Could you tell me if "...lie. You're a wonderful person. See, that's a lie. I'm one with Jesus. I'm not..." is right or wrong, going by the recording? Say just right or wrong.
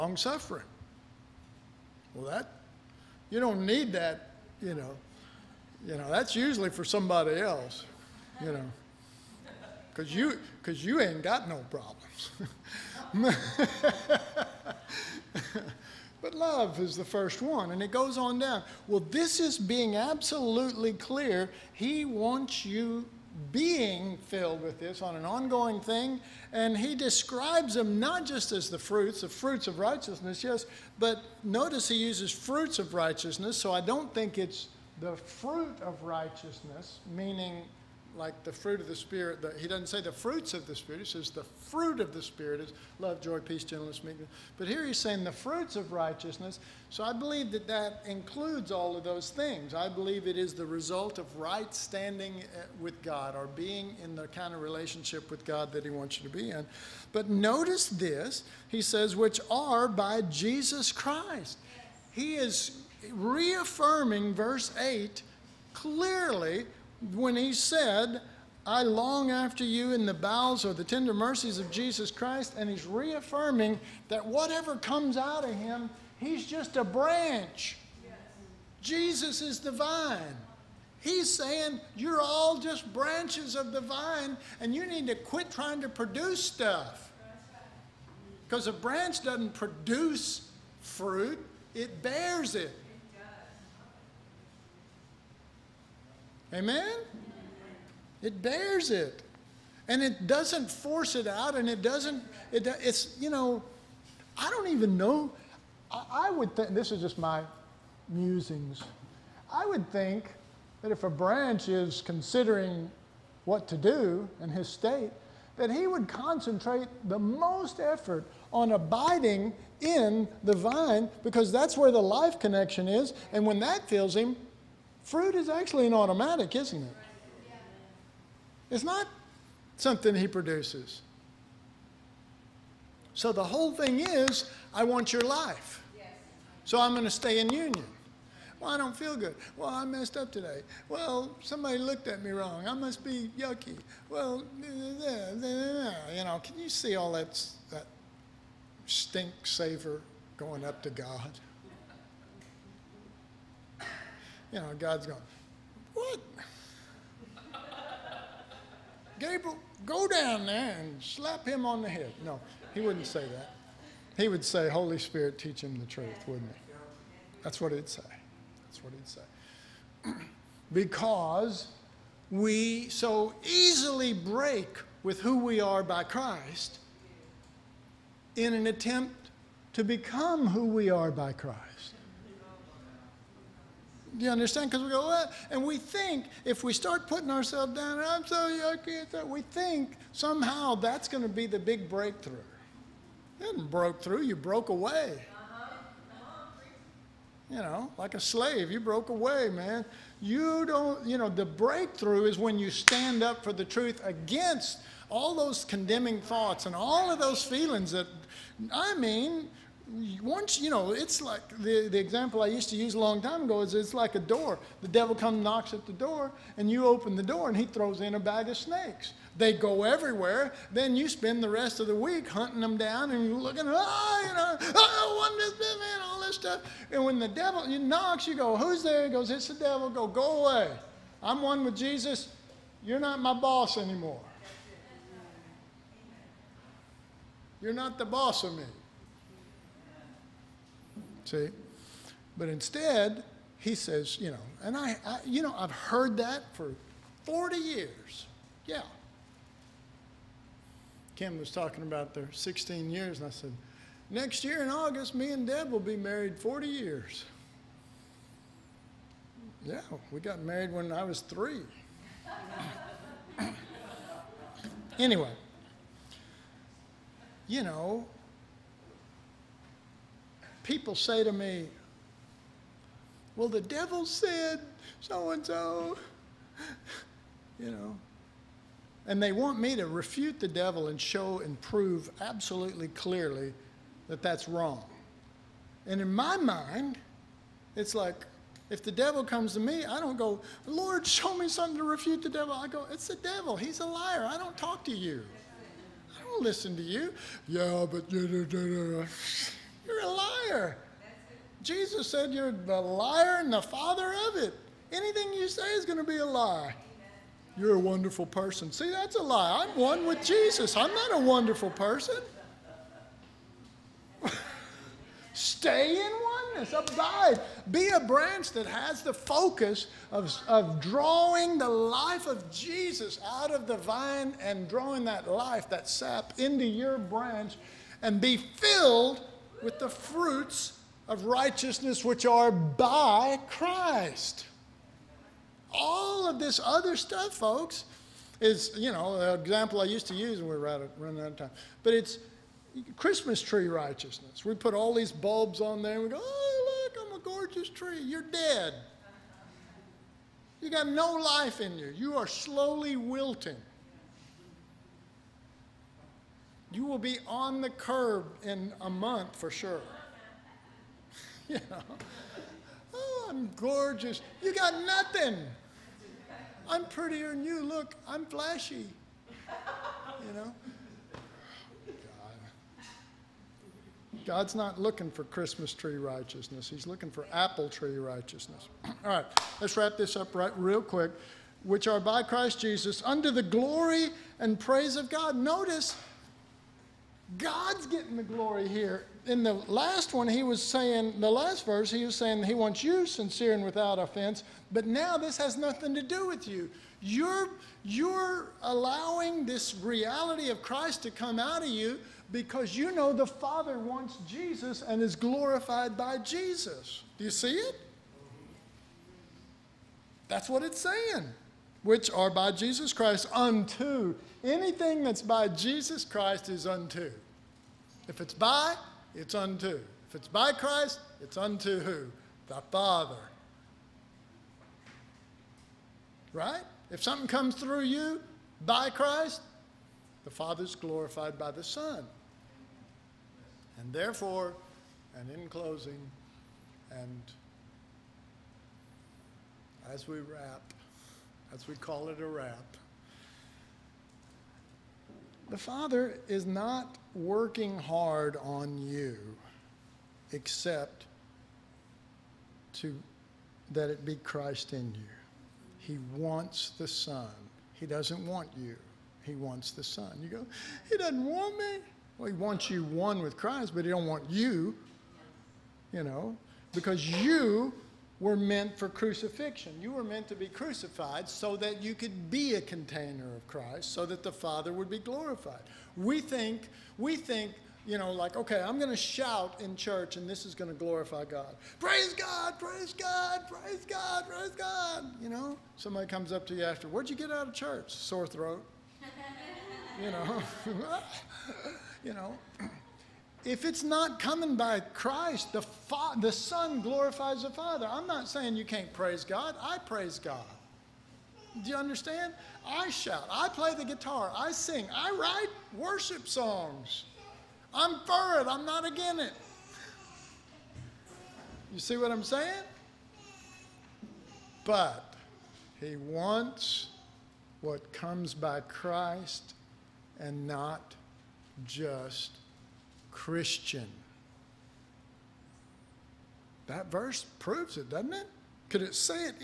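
right.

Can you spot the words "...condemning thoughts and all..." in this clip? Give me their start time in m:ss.
3:25.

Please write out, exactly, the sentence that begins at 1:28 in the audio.
Because a branch doesn't produce fruit, it bears it.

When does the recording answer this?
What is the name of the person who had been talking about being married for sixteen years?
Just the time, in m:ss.
4:11.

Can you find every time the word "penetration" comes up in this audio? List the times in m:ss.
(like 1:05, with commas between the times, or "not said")
not said.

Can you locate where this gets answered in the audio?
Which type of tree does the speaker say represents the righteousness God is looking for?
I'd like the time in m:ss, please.
6:17.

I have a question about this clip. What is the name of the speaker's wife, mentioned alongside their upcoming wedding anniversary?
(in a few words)
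Deb.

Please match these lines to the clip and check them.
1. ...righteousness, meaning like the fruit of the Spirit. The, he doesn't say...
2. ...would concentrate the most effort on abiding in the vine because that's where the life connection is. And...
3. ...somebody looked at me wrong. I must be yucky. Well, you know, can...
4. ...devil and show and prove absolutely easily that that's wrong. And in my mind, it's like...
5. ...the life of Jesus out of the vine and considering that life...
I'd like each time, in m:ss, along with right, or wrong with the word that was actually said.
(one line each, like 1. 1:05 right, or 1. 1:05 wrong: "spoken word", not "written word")
1. 0:36 right
2. 1:55 right
3. 2:21 right
4. 4:40 wrong: "clearly", not "easily"
5. 5:21 wrong: "drawing", not "considering".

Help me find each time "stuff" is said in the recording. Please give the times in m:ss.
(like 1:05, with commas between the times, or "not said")
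1:26, 3:46, 5:36.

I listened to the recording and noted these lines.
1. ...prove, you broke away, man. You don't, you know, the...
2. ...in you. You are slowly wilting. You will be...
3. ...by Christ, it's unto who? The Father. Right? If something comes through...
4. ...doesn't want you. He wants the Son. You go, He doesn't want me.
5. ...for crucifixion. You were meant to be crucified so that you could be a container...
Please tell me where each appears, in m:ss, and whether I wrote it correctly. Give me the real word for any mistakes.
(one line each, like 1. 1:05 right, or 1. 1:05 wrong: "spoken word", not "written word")
1. 3:18 wrong: "slave", not "prove"
2. 5:51 right
3. 7:00 right
4. 7:37 right
5. 7:48 right.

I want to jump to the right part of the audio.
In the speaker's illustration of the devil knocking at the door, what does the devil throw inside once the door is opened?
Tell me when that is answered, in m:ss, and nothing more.
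3:38.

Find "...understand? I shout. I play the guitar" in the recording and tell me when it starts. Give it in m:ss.
8:21.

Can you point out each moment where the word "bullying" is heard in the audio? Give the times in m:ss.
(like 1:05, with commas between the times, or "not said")
not said.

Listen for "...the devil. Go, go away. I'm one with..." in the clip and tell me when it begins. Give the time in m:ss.
3:49.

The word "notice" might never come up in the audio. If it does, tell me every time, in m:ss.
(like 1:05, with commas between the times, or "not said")
0:31, 0:57, 6:25.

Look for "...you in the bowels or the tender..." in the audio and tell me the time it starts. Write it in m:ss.
1:09.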